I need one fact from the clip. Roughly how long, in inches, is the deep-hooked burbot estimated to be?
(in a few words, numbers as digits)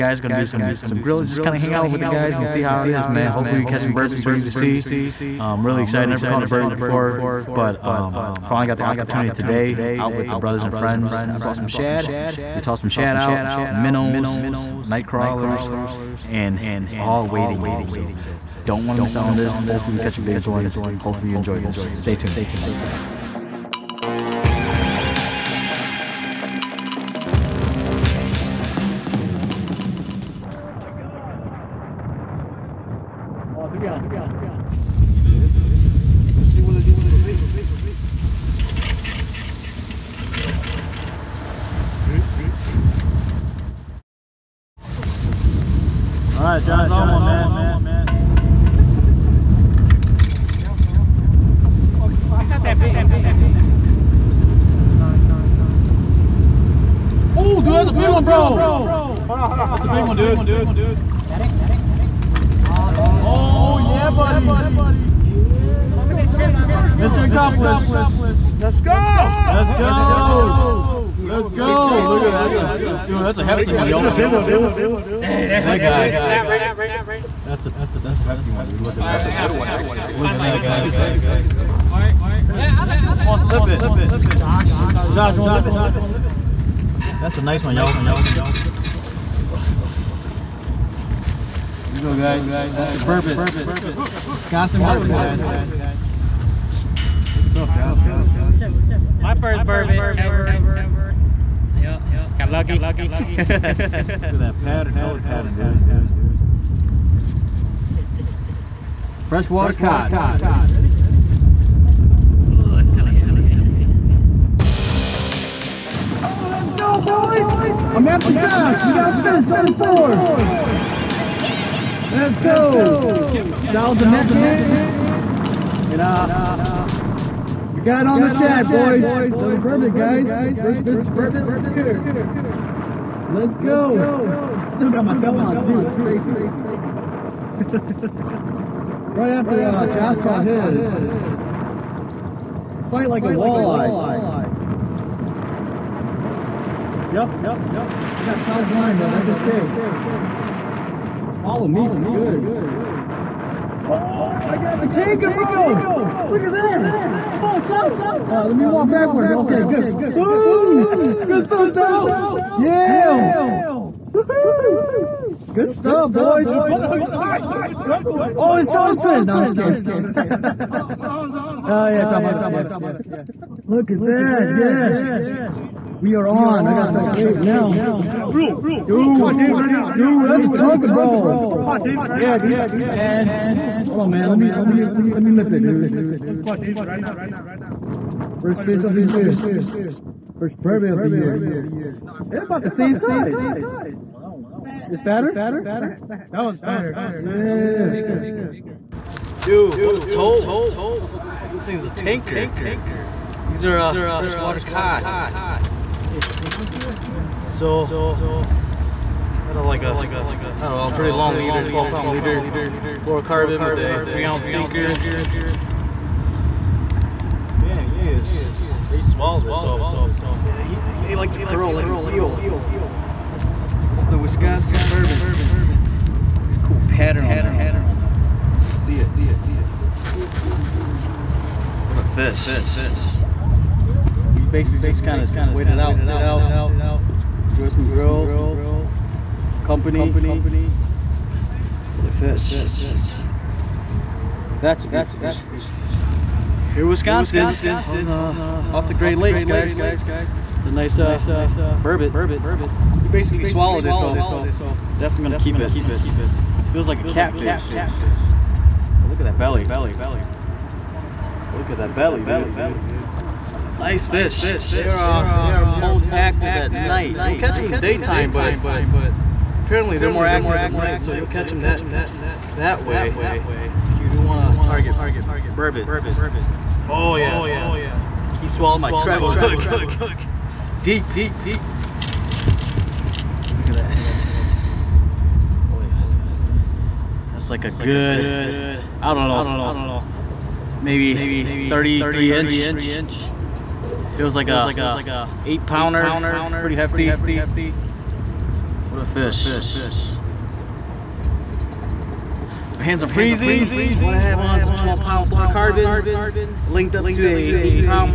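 33.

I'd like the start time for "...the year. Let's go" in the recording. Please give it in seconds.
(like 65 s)
131 s.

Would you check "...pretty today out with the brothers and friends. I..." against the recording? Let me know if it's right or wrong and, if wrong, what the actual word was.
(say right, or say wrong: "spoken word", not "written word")
wrong: "opportunity", not "pretty".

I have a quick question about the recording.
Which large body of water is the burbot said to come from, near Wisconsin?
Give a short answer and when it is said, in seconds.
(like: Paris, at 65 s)
Great Lakes, at 248 s.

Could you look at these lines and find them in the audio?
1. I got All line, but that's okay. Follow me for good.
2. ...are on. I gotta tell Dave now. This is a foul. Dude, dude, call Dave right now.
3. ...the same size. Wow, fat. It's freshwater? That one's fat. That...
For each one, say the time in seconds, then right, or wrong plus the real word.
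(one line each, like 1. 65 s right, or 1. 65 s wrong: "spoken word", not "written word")
1. 147 s wrong: "Charles", not "All"
2. 176 s right
3. 192 s wrong: "fatter", not "freshwater".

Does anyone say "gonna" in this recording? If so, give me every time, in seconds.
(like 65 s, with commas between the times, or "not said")
0 s, 181 s, 255 s.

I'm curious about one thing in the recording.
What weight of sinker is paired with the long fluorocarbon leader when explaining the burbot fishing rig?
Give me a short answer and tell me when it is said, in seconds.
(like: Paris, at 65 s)
3 ounce, at 214 s.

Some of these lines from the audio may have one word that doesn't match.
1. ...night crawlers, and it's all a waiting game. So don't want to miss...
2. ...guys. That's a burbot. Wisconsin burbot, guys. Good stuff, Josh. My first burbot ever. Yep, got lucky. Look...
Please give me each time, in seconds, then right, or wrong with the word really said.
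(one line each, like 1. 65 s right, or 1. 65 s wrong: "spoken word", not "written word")
1. 14 s right
2. 92 s right.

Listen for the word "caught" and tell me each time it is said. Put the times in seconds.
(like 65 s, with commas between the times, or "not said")
6 s, 140 s.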